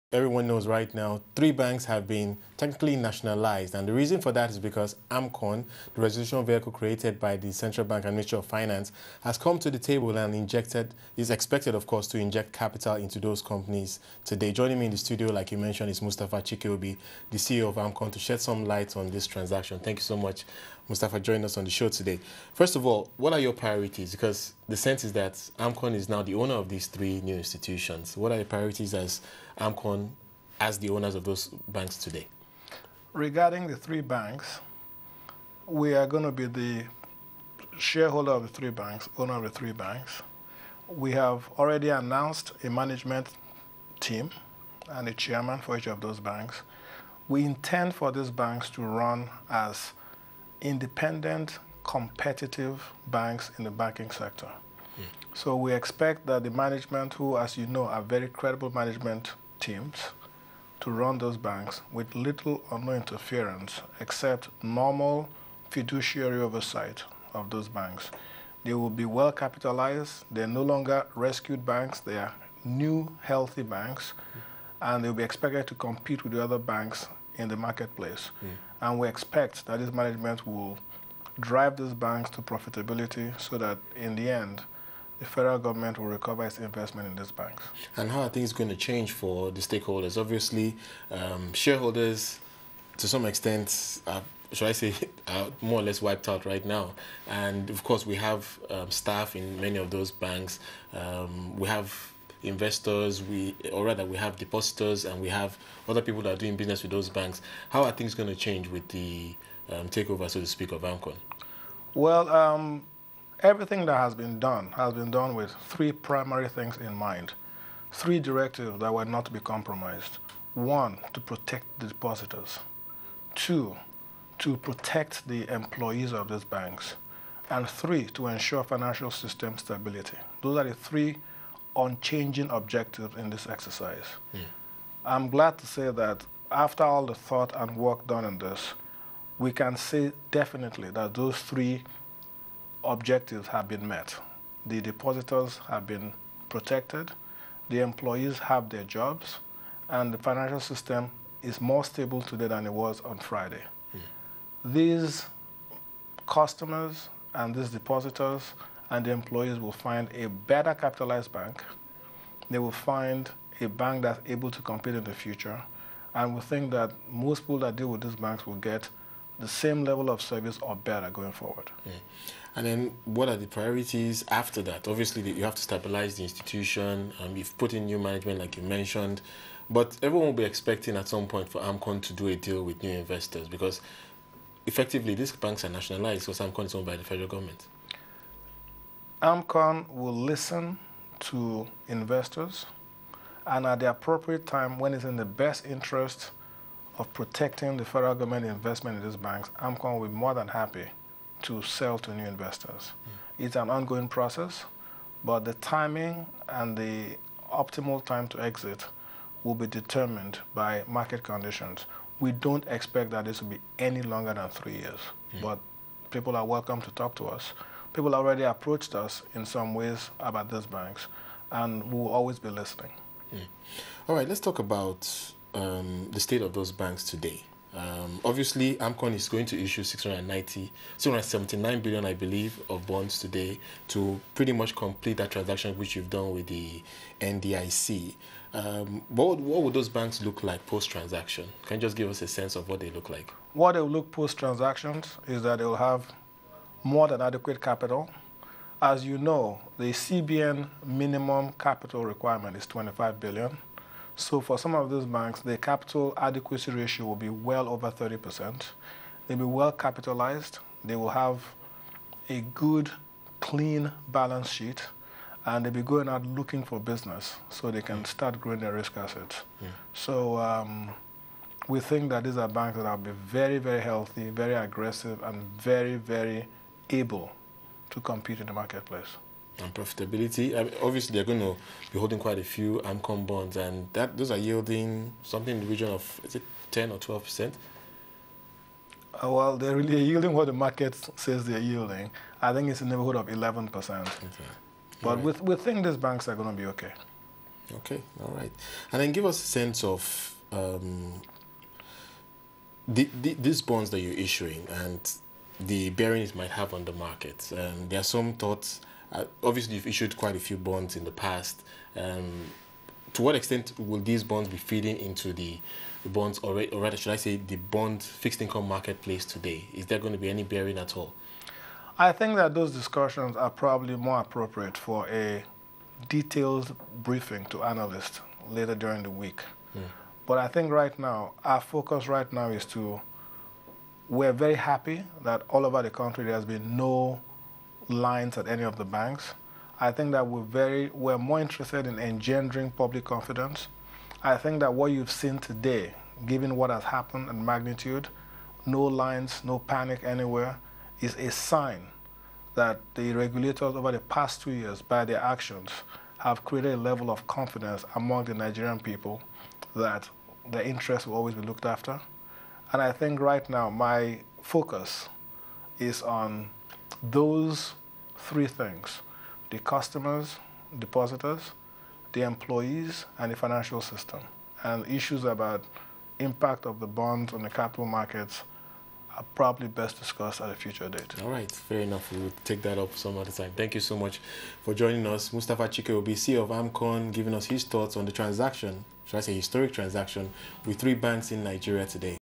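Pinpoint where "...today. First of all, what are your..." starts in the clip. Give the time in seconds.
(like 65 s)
21 s.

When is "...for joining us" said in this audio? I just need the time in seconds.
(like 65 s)
384 s.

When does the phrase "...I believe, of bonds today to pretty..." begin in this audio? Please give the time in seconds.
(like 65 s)
232 s.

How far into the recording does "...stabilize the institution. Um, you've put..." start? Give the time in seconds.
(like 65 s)
175 s.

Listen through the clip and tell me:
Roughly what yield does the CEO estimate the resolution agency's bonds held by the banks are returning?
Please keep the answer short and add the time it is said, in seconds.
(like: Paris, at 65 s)
11 percent, at 293 s.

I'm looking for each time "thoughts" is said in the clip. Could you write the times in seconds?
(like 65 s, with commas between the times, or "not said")
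137 s, 308 s, 387 s.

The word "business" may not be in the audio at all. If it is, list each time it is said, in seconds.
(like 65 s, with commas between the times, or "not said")
106 s, 266 s.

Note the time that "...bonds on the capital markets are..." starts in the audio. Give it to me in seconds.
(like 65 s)
376 s.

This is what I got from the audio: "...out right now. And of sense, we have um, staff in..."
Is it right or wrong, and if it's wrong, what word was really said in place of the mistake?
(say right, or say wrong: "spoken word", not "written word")
wrong: "course", not "sense".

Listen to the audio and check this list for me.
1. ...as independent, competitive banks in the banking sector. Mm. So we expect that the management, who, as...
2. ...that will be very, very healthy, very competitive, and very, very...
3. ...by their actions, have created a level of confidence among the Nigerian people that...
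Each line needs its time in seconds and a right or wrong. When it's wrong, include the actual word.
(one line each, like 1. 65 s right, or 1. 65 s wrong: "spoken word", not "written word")
1. 49 s right
2. 272 s wrong: "aggressive", not "competitive"
3. 354 s right.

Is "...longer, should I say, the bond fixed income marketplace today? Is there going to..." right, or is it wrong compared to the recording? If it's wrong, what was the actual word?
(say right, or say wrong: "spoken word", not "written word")
wrong: "rather", not "longer".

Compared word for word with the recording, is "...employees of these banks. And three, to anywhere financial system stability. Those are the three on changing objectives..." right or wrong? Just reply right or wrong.
wrong.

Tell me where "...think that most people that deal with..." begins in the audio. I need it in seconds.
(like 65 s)
166 s.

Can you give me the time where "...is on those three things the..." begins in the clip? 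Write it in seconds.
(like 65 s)
365 s.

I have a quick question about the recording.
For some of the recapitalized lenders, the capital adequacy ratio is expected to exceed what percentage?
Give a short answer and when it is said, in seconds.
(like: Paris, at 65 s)
30%, at 257 s.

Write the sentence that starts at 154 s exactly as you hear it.
These customers and these depositors and the employees will find a better capitalized bank.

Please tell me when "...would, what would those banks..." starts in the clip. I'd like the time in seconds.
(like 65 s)
239 s.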